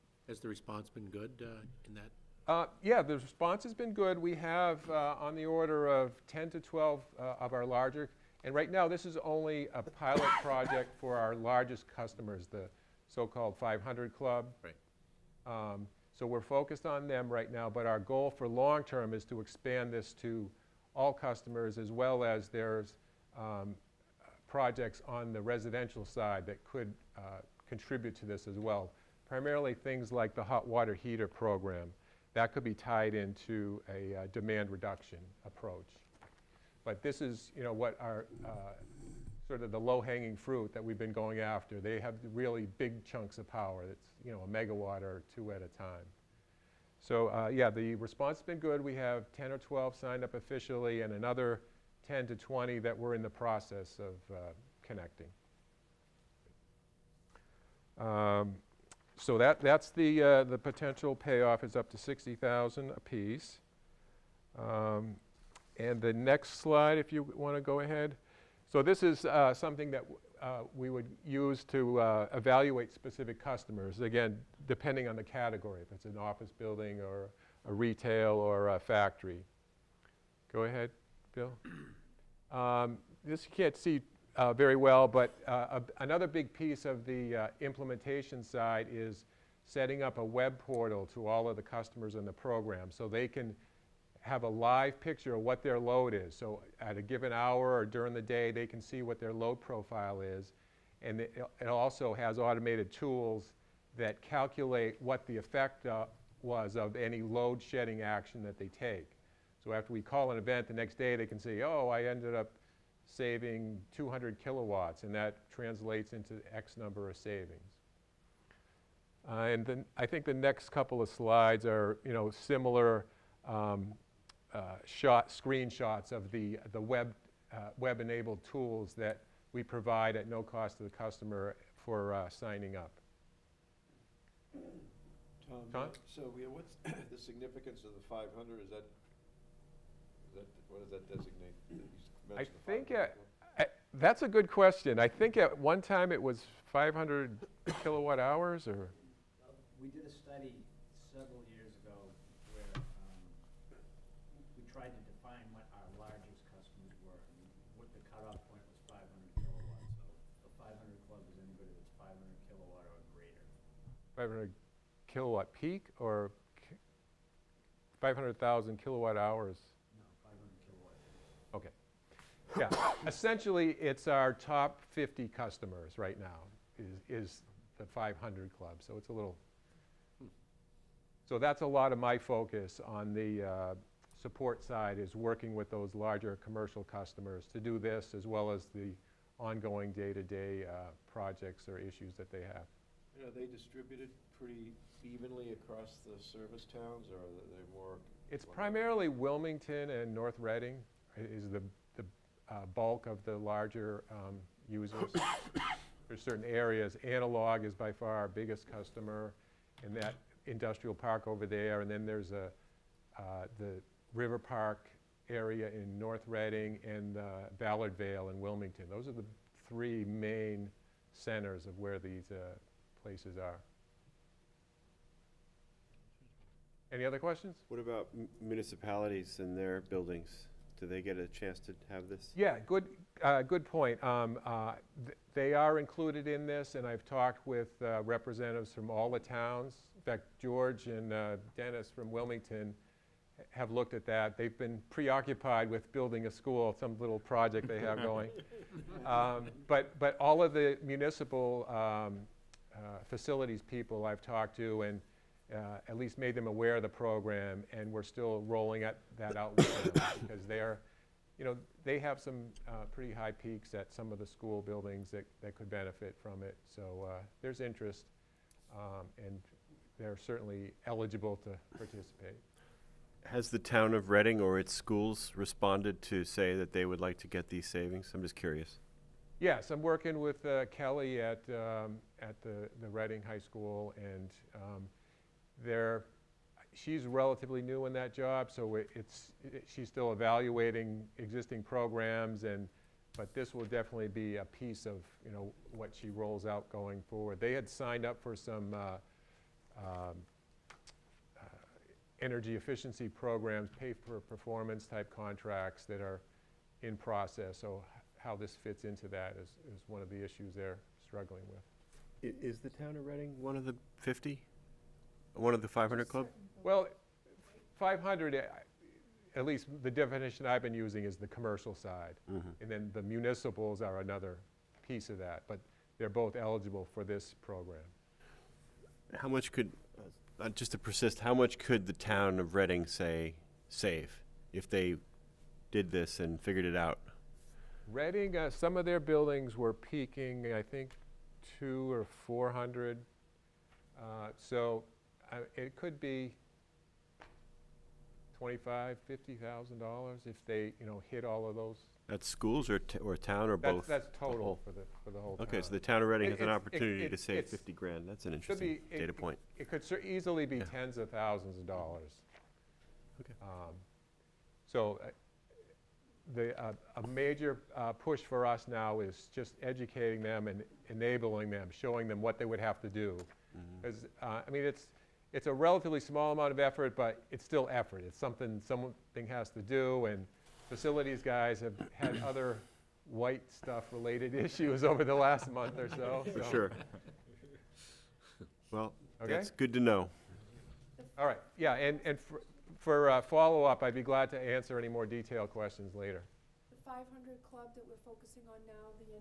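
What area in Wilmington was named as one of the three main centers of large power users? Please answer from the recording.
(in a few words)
Ballard Vale.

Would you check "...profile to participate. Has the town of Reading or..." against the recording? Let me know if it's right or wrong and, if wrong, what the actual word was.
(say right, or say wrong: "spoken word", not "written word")
wrong: "eligible", not "profile".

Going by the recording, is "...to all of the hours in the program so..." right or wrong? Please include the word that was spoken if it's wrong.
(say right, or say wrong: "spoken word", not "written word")
wrong: "customers", not "hours".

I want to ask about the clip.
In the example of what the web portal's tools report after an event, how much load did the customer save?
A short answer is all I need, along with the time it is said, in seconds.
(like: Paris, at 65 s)
200 kilowatts, at 113 s.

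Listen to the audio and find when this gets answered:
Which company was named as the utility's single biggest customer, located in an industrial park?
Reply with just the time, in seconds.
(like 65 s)
207 s.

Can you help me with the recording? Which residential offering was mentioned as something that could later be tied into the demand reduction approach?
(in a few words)
hot water heater program.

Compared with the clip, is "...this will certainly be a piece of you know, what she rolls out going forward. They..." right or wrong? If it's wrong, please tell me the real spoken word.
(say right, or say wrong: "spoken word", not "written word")
wrong: "definitely", not "certainly".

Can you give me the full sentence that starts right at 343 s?
Uh, so uh, it could be 25, $50,000 if they, you know, hit all of those.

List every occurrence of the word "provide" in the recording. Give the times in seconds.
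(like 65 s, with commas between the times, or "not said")
129 s.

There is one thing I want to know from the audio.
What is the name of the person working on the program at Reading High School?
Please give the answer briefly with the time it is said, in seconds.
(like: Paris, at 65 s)
Kelly, at 280 s.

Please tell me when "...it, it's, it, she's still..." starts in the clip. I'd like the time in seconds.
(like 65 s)
288 s.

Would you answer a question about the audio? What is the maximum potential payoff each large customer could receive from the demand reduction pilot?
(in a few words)
60,000.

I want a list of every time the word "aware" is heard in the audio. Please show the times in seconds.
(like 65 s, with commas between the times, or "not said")
256 s.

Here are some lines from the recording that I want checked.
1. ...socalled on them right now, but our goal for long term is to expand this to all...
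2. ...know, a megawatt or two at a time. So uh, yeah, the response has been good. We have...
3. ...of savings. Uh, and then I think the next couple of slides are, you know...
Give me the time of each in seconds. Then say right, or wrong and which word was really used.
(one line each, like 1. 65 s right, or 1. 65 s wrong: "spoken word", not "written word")
1. 16 s wrong: "focused", not "socalled"
2. 44 s right
3. 117 s right.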